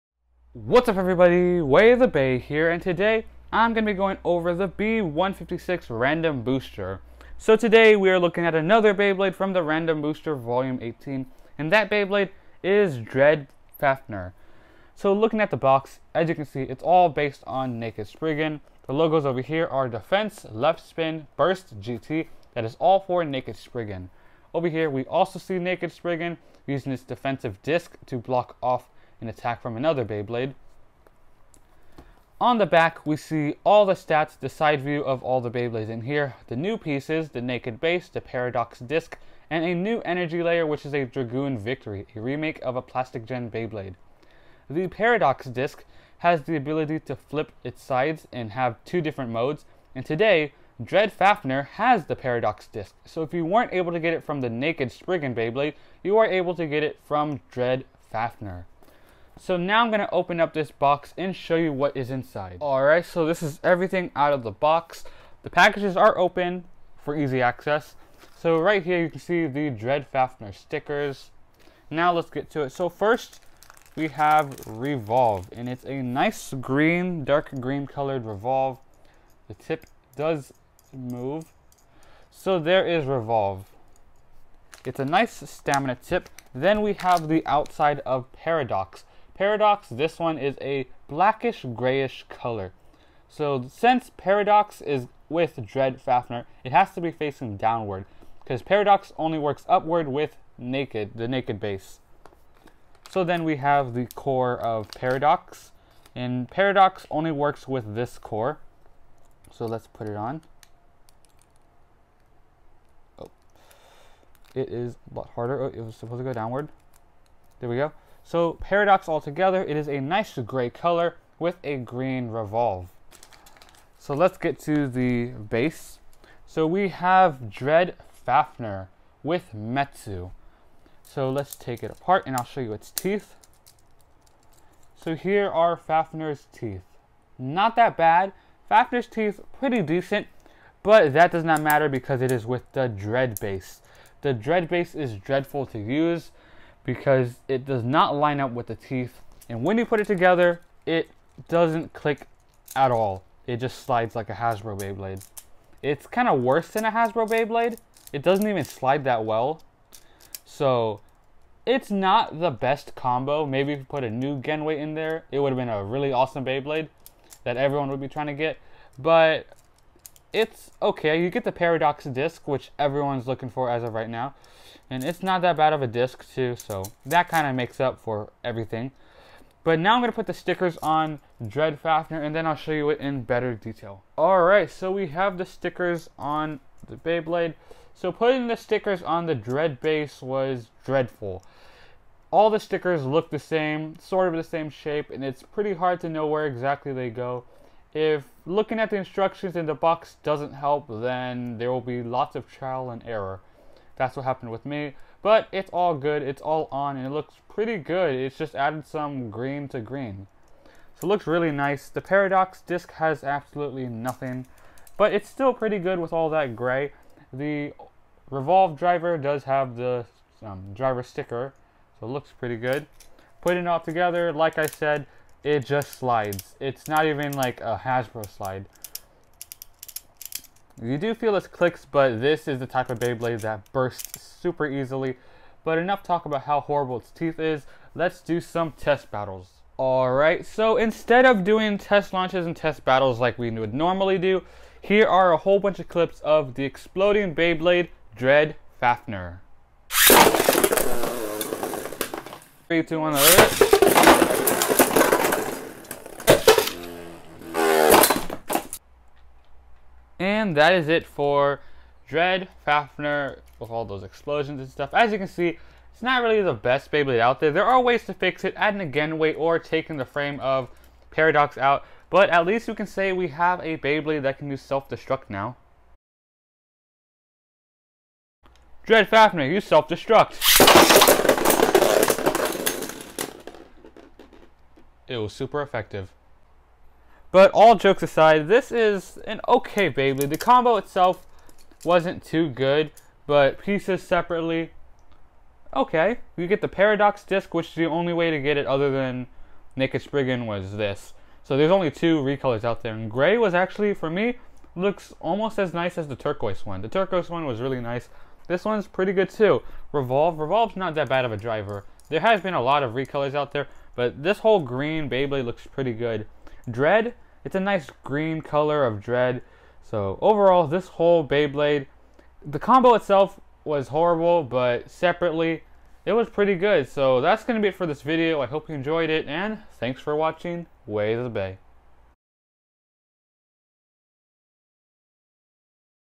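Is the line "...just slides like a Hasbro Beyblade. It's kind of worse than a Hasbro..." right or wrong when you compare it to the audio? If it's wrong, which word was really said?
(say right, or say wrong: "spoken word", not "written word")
right.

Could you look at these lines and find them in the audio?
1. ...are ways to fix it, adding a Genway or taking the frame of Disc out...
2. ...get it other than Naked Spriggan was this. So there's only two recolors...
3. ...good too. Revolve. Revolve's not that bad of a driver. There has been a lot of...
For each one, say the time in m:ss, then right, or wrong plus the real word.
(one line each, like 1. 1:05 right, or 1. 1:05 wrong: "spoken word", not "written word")
1. 4:27 wrong: "Paradox", not "Disc"
2. 4:58 right
3. 5:09 right.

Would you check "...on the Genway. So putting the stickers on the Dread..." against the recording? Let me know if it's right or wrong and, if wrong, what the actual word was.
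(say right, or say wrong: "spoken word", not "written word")
wrong: "Beyblade", not "Genway".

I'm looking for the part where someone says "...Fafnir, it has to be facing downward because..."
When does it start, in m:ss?
1:36.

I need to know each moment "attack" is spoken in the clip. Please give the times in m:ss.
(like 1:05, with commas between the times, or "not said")
0:29.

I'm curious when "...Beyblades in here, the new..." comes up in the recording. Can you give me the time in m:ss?
0:35.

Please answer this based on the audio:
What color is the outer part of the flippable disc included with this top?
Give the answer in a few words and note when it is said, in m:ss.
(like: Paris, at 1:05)
Blackish grayish, at 1:31.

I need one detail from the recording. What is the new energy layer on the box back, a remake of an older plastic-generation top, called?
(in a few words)
Dragoon Victory.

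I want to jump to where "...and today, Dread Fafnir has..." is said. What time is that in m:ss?
0:49.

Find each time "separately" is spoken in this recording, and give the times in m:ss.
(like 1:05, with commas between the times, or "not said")
4:54, 5:24.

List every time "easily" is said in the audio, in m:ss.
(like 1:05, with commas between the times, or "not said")
3:54.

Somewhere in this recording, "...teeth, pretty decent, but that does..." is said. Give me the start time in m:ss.
2:19.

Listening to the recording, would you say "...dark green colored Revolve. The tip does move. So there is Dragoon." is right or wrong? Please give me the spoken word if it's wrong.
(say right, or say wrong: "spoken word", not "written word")
wrong: "Revolve", not "Dragoon".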